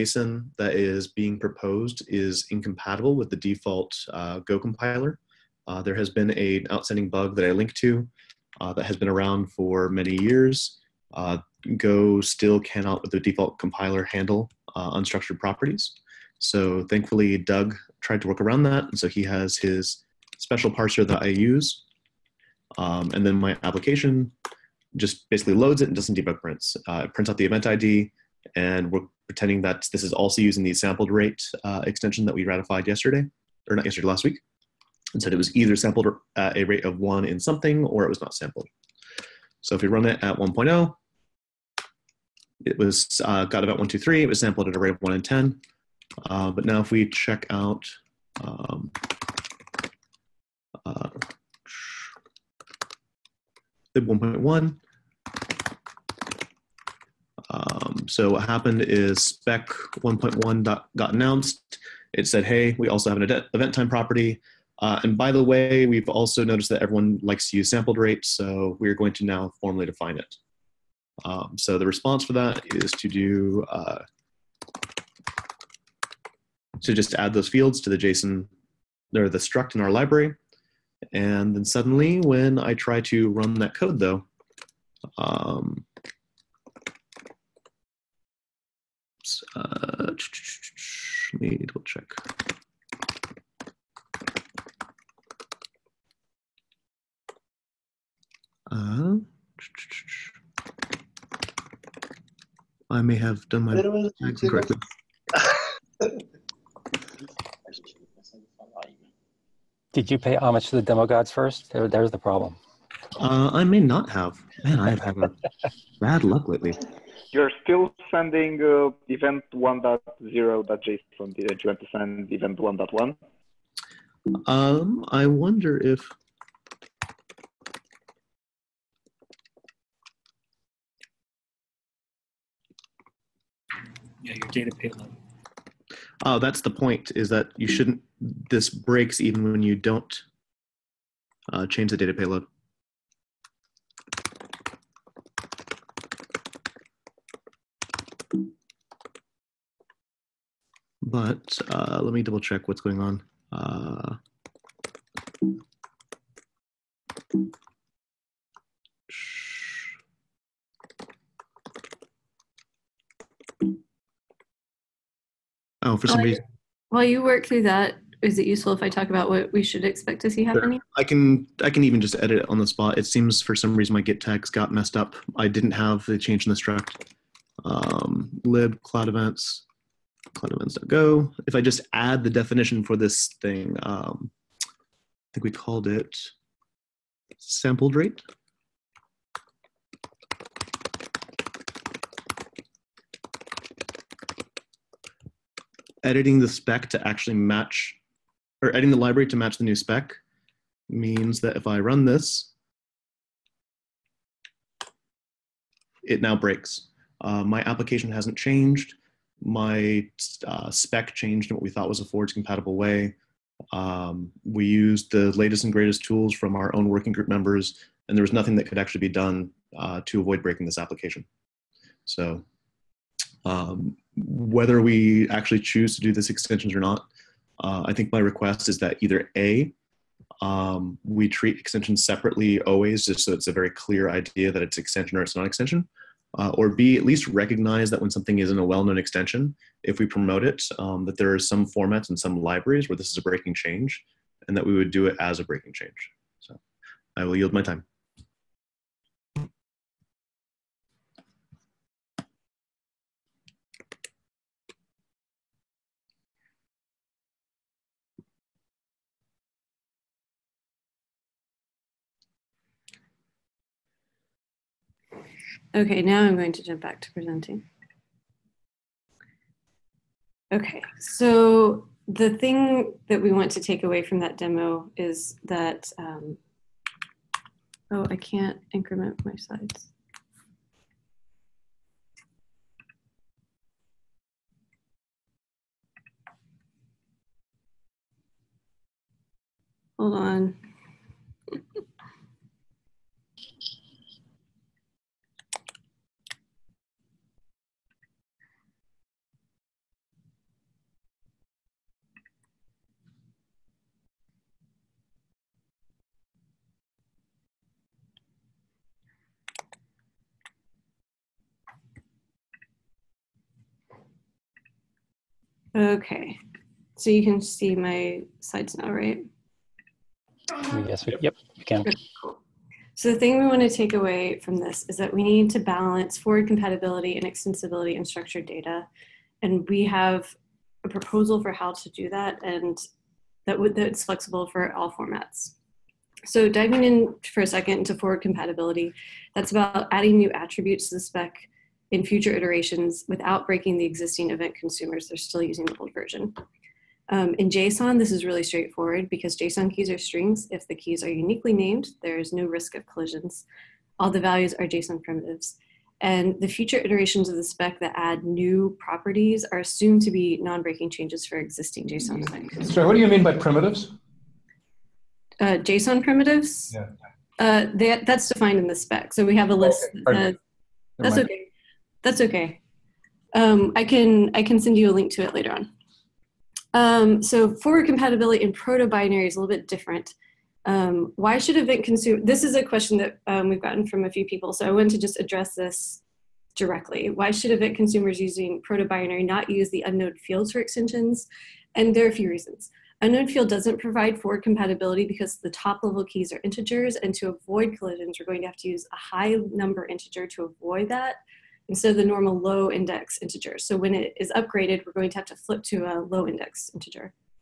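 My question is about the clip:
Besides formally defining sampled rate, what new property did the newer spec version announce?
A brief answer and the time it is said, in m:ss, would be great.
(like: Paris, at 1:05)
event time, at 1:03.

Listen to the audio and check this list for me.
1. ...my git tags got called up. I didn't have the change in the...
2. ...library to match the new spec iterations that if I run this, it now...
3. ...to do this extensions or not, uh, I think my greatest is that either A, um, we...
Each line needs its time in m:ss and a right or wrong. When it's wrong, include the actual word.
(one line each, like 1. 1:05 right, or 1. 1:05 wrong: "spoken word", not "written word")
1. 2:53 wrong: "messed", not "called"
2. 3:18 wrong: "means", not "iterations"
3. 3:45 wrong: "request", not "greatest".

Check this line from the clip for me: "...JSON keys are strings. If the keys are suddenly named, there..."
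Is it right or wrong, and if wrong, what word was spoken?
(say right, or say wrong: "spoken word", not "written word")
wrong: "uniquely", not "suddenly".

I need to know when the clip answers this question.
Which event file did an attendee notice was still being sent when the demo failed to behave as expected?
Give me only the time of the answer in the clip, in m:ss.
1:59.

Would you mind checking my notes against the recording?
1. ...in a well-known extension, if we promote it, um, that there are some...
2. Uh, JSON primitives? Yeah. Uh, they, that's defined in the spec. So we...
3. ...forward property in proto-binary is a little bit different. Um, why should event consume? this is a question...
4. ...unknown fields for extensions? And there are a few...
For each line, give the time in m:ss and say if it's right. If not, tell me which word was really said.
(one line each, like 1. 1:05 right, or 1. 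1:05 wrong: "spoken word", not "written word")
1. 3:58 right
2. 6:05 right
3. 6:17 wrong: "compatibility", not "property"
4. 6:29 right.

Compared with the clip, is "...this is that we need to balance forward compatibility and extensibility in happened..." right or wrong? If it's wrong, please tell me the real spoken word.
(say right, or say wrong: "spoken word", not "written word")
wrong: "structured", not "happened".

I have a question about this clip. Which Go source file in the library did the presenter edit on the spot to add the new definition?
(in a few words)
cloudevents.go.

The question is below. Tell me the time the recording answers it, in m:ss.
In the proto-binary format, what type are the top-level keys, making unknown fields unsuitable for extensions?
6:36.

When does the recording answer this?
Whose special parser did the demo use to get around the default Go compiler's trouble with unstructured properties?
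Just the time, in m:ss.
0:17.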